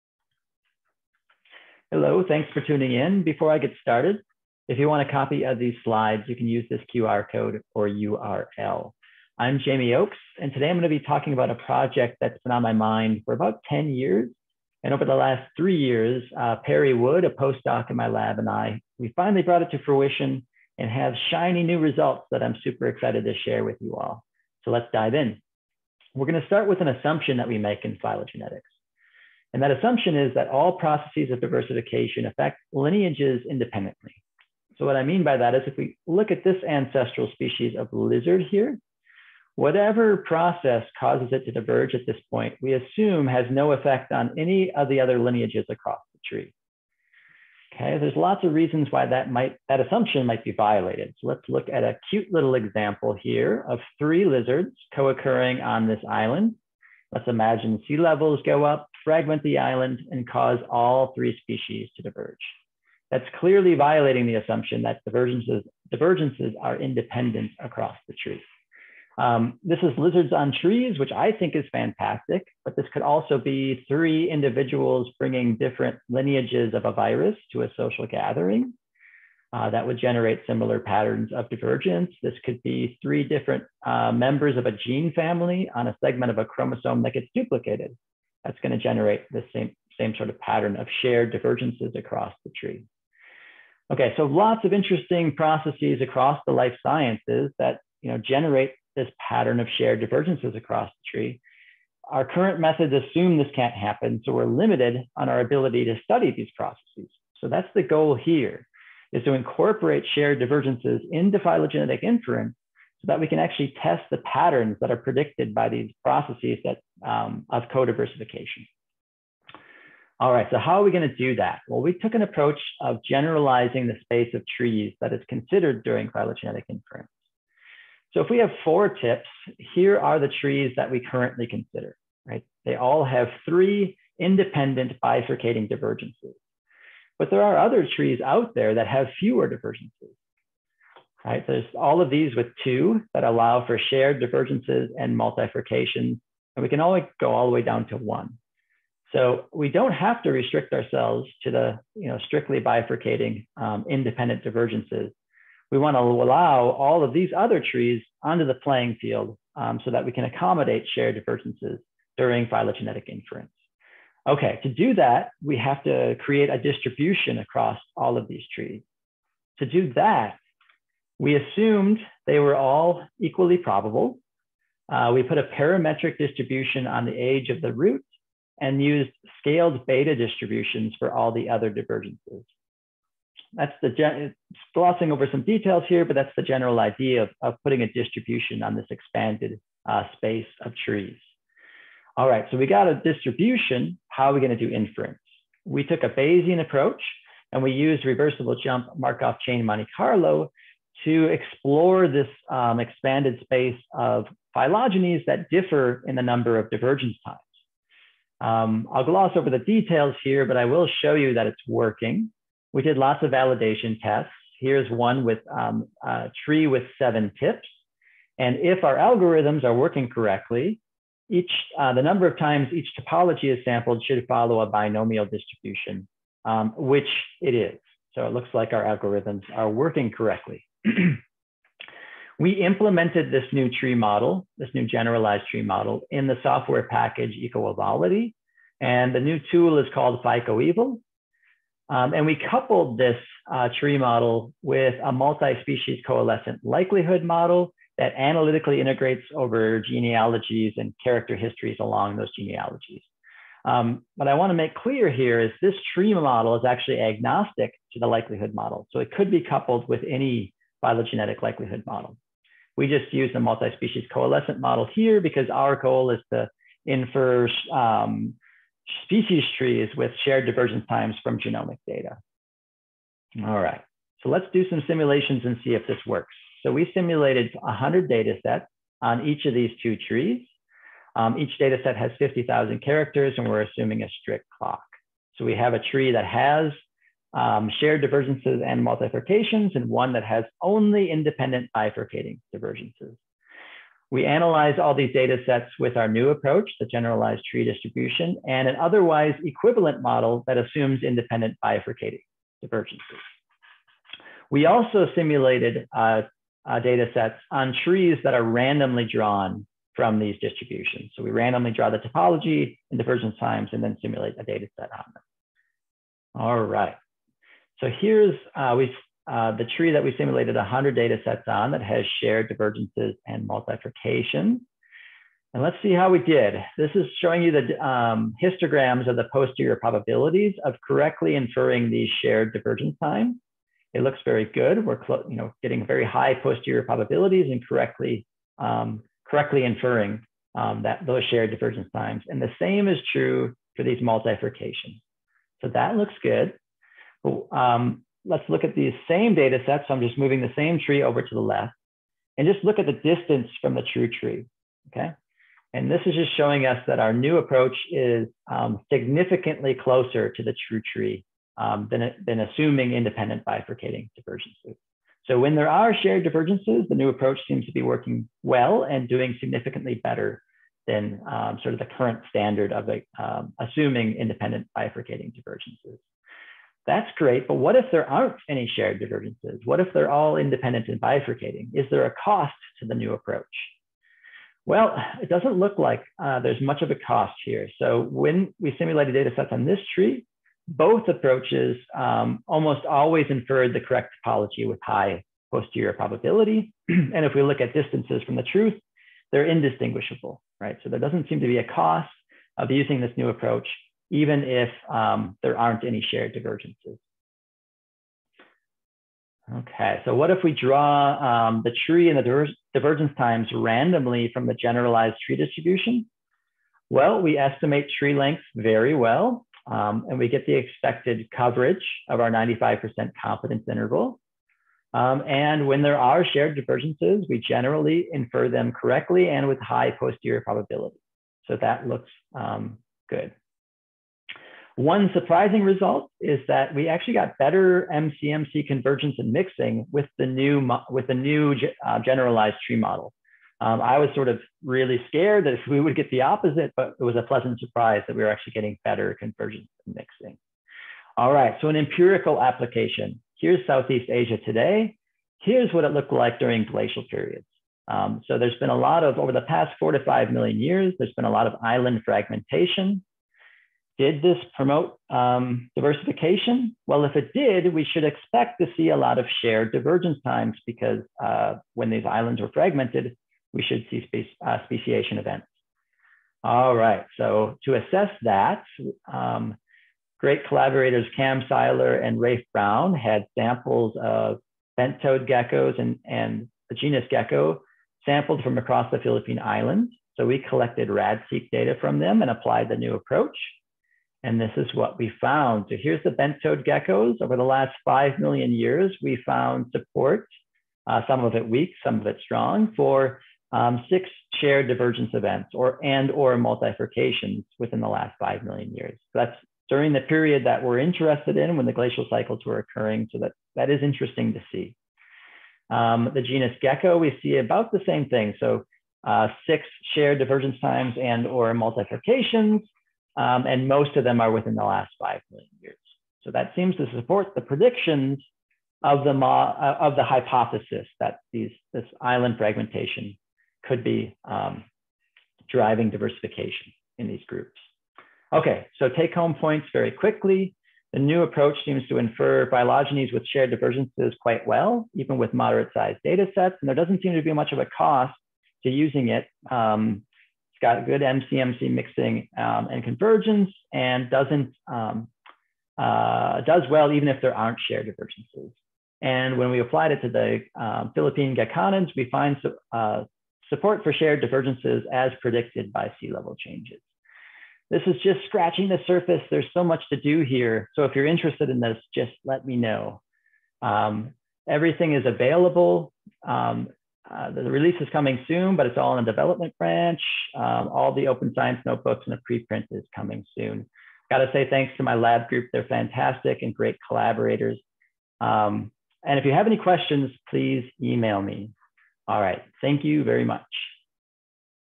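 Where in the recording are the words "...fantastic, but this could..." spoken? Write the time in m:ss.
1:11.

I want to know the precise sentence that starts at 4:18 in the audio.
So it could be coupled with any phylogenetic likelihood model.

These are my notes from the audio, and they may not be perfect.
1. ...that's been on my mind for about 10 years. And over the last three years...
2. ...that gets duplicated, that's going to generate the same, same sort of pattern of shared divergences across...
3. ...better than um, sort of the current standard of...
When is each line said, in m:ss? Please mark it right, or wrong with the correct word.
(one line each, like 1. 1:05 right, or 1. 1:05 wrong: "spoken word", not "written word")
1. 0:12 right
2. 1:27 right
3. 6:10 right.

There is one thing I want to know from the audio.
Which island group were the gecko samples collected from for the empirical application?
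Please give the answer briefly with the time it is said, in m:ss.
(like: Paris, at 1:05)
Philippine Islands, at 8:08.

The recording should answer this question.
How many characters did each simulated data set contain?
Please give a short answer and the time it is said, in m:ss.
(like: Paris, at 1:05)
50,000, at 4:42.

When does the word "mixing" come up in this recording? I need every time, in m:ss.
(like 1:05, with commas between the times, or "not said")
7:19, 7:29, 9:11.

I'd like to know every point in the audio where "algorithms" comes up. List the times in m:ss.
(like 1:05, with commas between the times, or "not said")
3:38, 3:48.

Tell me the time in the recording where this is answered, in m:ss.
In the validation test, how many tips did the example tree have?
3:36.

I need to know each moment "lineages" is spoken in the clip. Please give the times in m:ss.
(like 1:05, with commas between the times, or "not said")
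0:32, 0:45, 1:16.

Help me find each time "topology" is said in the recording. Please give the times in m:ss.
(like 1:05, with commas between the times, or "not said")
3:42, 5:11, 6:34.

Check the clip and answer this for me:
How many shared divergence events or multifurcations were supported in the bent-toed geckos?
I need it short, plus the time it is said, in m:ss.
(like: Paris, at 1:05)
6, at 8:23.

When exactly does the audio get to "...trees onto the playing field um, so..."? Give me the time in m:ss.
2:37.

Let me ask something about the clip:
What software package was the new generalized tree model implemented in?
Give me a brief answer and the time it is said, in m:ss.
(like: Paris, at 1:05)
EcoEvality, at 3:57.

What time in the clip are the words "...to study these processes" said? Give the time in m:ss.
1:45.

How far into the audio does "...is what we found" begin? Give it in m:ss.
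8:14.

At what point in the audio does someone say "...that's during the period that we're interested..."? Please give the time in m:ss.
8:29.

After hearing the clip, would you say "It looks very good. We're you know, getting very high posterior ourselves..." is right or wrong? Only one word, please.
wrong.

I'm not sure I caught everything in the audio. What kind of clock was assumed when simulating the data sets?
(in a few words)
Strict clock.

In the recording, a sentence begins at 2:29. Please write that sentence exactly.
So we don't have to restrict ourselves to the you know, strictly bifurcating um, independent divergences.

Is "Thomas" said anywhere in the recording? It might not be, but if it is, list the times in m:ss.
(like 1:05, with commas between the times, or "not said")
not said.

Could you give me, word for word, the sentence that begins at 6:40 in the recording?
So there doesn't seem to be a cost of using this new approach even if um, there aren't any shared divergences.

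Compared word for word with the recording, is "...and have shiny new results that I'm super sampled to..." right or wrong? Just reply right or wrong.
wrong.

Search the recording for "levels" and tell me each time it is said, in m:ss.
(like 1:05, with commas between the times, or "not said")
0:57, 9:26.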